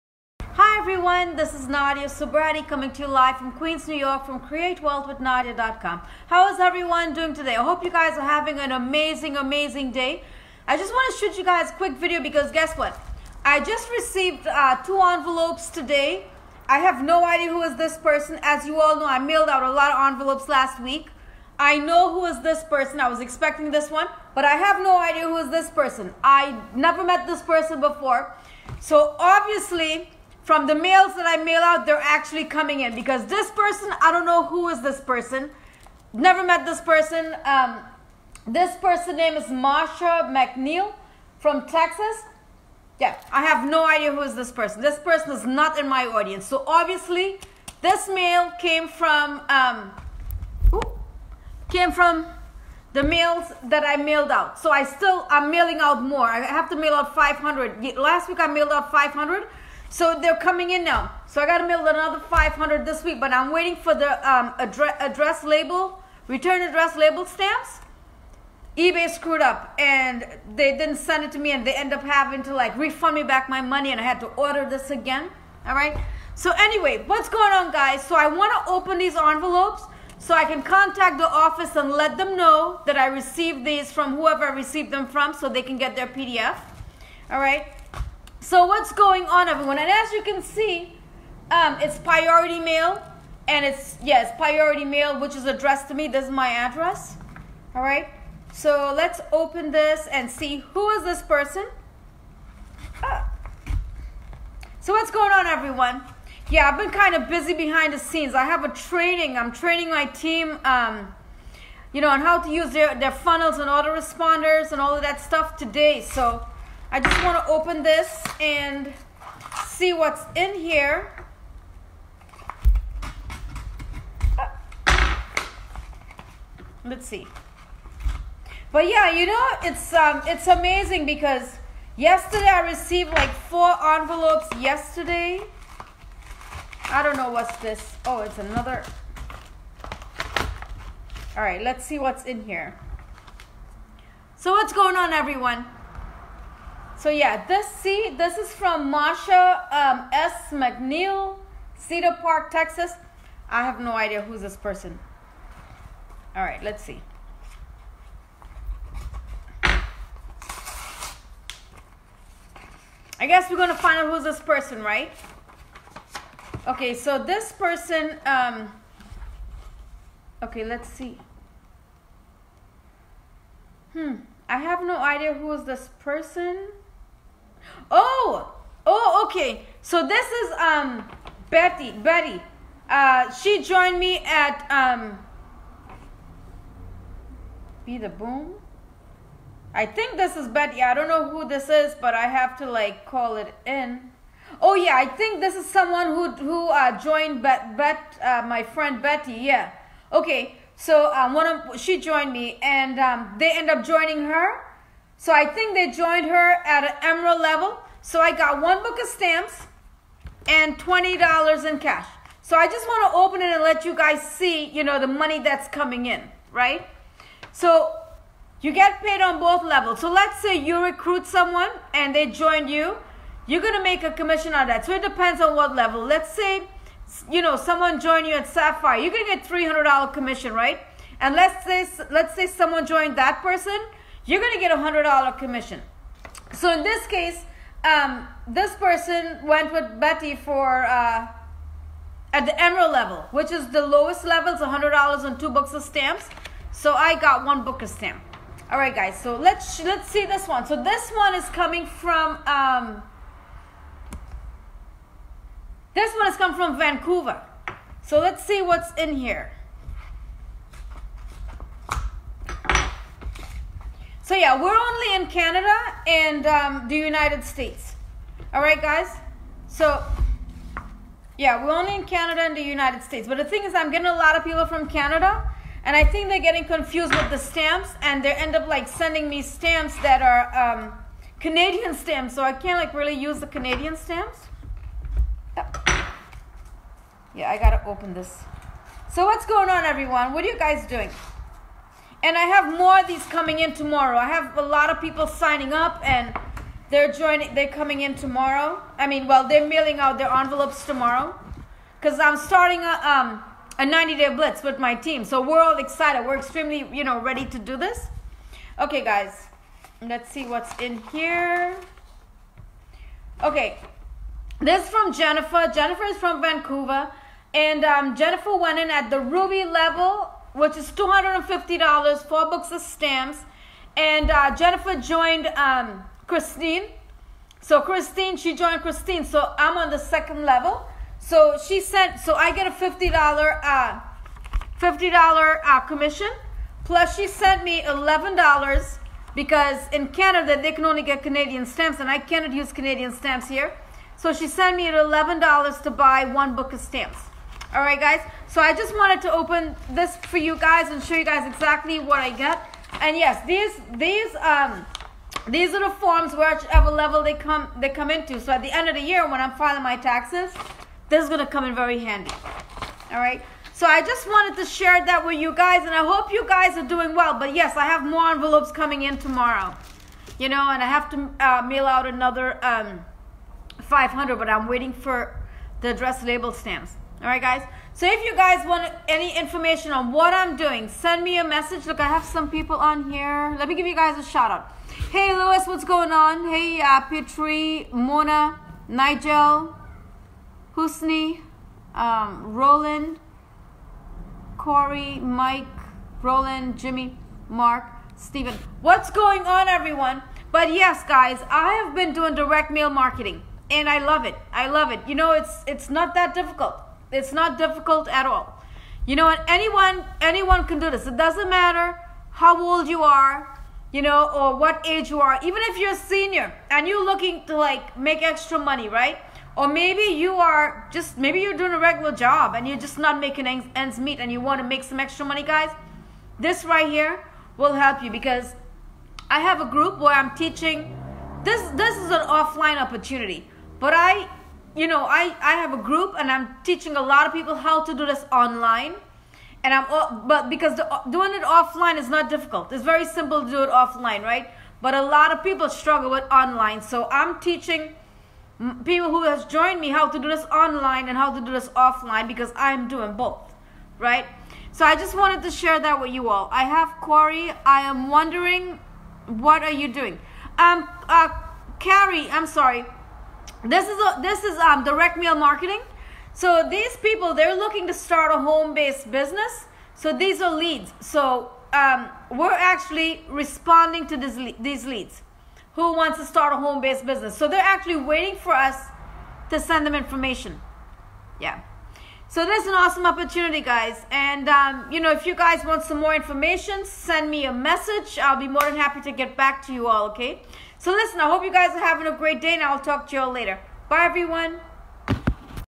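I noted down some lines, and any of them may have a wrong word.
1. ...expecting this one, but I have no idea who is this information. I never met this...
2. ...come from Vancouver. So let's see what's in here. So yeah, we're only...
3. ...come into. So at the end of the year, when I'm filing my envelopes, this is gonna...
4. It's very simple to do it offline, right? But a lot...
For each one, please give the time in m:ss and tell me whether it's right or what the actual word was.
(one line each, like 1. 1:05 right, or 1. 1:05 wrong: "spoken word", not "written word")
1. 0:23 wrong: "person", not "information"
2. 4:16 right
3. 5:57 wrong: "taxes", not "envelopes"
4. 7:22 right.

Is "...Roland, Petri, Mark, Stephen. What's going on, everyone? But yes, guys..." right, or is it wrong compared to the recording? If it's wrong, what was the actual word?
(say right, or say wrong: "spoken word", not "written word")
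wrong: "Jimmy", not "Petri".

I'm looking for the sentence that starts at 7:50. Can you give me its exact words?
So um, we're actually responding to this, these leads who wants to start a home-based business.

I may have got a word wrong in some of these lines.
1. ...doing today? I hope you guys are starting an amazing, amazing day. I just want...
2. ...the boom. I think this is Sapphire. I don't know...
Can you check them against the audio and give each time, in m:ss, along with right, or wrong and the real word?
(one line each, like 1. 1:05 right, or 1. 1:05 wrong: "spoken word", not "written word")
1. 0:07 wrong: "having", not "starting"
2. 3:07 wrong: "Betty", not "Sapphire".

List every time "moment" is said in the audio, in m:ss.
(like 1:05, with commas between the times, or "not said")
not said.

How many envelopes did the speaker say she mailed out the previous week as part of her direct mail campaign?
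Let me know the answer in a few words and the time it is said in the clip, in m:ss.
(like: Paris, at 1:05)
500, at 0:57.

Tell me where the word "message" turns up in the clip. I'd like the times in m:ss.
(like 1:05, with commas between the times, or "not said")
6:21, 8:07.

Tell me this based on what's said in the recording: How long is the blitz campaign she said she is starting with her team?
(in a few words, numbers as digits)
90 days.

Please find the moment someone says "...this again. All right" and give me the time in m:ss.
1:14.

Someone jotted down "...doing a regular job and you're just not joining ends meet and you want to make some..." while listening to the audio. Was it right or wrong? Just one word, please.
wrong.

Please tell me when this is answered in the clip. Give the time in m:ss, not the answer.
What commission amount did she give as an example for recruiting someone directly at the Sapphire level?
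3:49.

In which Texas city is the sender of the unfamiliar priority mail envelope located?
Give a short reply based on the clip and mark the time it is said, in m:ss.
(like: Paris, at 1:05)
Cedar Park, at 2:31.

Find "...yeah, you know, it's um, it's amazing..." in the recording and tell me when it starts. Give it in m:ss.
2:08.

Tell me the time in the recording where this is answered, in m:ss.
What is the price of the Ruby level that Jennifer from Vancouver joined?
5:20.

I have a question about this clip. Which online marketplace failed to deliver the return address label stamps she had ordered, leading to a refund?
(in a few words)
eBay.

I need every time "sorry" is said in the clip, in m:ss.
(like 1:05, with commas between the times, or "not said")
7:42.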